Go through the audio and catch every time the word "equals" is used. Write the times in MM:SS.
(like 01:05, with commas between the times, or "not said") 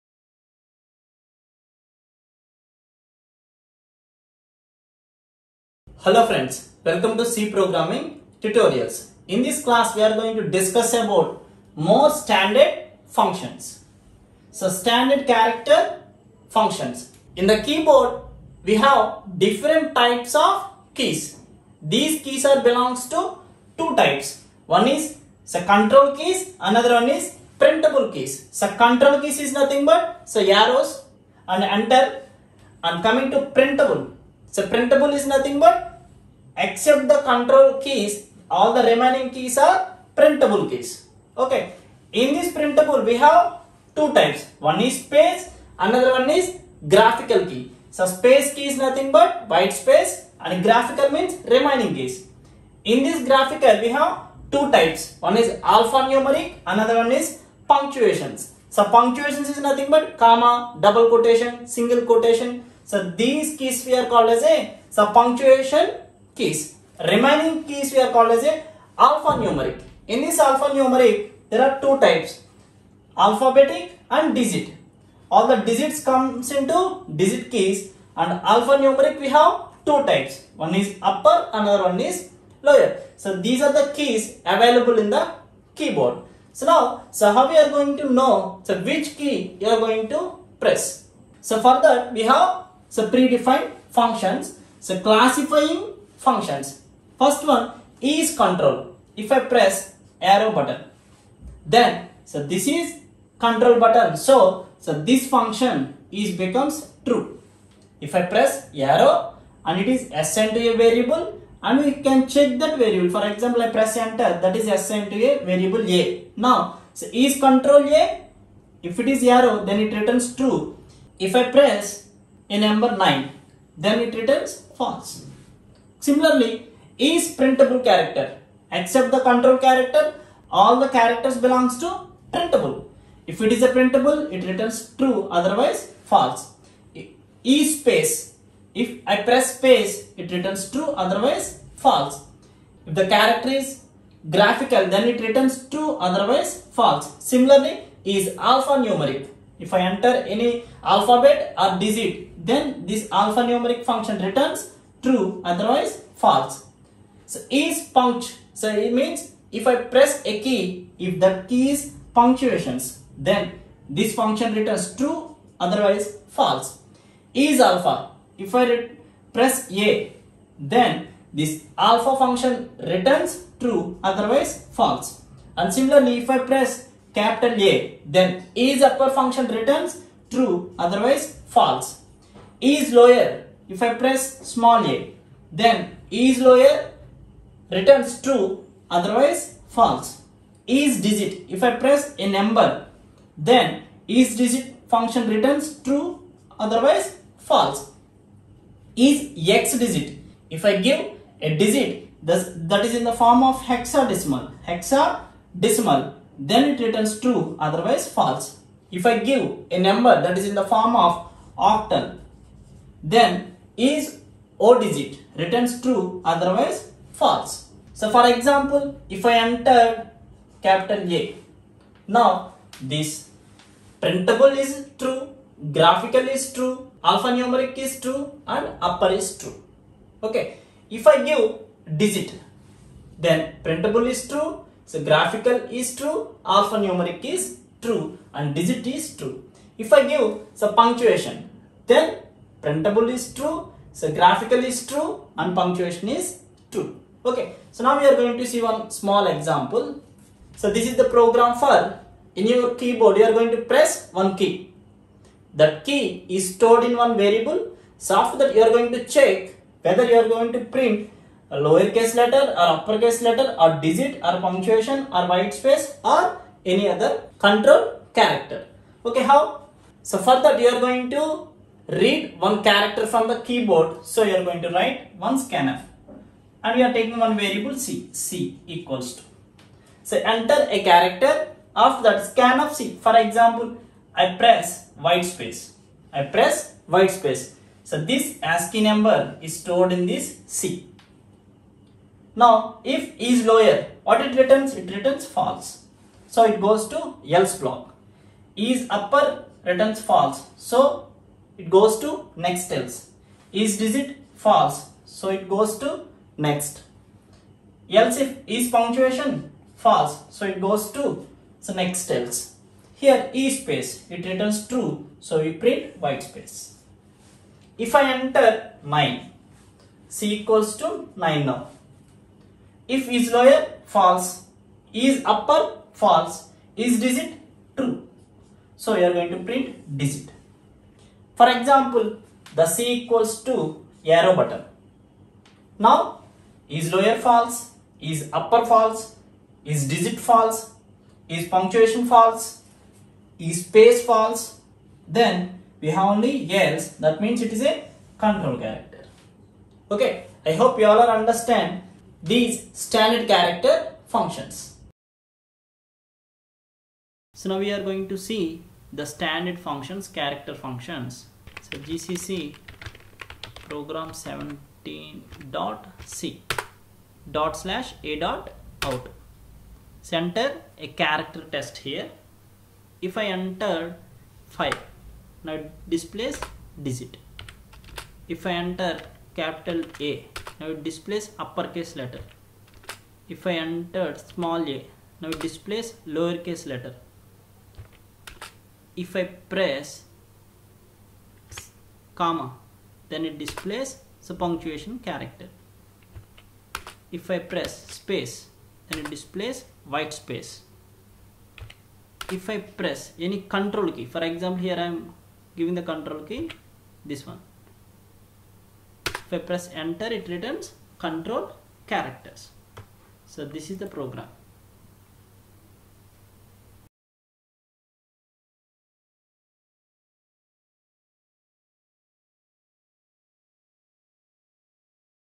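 04:38, 05:20, 05:33.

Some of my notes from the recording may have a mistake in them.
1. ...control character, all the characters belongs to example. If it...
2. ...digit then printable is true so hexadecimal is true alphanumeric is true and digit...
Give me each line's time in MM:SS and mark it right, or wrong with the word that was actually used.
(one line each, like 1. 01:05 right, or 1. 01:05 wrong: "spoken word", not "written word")
1. 02:09 wrong: "printable", not "example"
2. 03:51 wrong: "graphical", not "hexadecimal".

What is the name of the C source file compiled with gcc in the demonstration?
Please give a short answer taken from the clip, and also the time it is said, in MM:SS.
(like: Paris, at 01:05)
program 17.c, at 06:03.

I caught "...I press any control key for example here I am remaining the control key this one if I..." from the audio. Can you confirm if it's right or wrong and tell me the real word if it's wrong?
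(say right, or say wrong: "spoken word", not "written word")
wrong: "giving", not "remaining".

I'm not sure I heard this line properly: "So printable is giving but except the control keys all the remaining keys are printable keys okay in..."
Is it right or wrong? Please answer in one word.
wrong.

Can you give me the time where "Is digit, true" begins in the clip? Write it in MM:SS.
05:26.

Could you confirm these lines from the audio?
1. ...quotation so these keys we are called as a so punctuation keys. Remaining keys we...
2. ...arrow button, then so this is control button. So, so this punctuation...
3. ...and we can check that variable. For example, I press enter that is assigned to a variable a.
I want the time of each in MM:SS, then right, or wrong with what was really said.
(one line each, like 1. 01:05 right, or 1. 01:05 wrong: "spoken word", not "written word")
1. 01:02 right
2. 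01:40 wrong: "function", not "punctuation"
3. 01:51 right.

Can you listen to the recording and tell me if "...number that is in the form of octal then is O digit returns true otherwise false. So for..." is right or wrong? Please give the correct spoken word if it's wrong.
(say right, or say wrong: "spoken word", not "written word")
right.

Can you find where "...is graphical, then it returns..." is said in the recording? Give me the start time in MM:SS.
02:23.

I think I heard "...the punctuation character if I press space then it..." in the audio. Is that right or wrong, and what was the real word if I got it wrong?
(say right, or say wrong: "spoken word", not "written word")
right.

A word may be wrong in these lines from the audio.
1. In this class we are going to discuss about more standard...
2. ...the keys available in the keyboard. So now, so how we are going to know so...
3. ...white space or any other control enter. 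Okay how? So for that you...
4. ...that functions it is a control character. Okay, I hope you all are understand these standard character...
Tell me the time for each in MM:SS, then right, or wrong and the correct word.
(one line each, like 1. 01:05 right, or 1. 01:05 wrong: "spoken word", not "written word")
1. 00:09 right
2. 01:23 right
3. 04:25 wrong: "character", not "enter"
4. 05:47 wrong: "means", not "functions".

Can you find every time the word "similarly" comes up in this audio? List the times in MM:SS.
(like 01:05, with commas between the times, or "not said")
02:06, 02:27, 02:55.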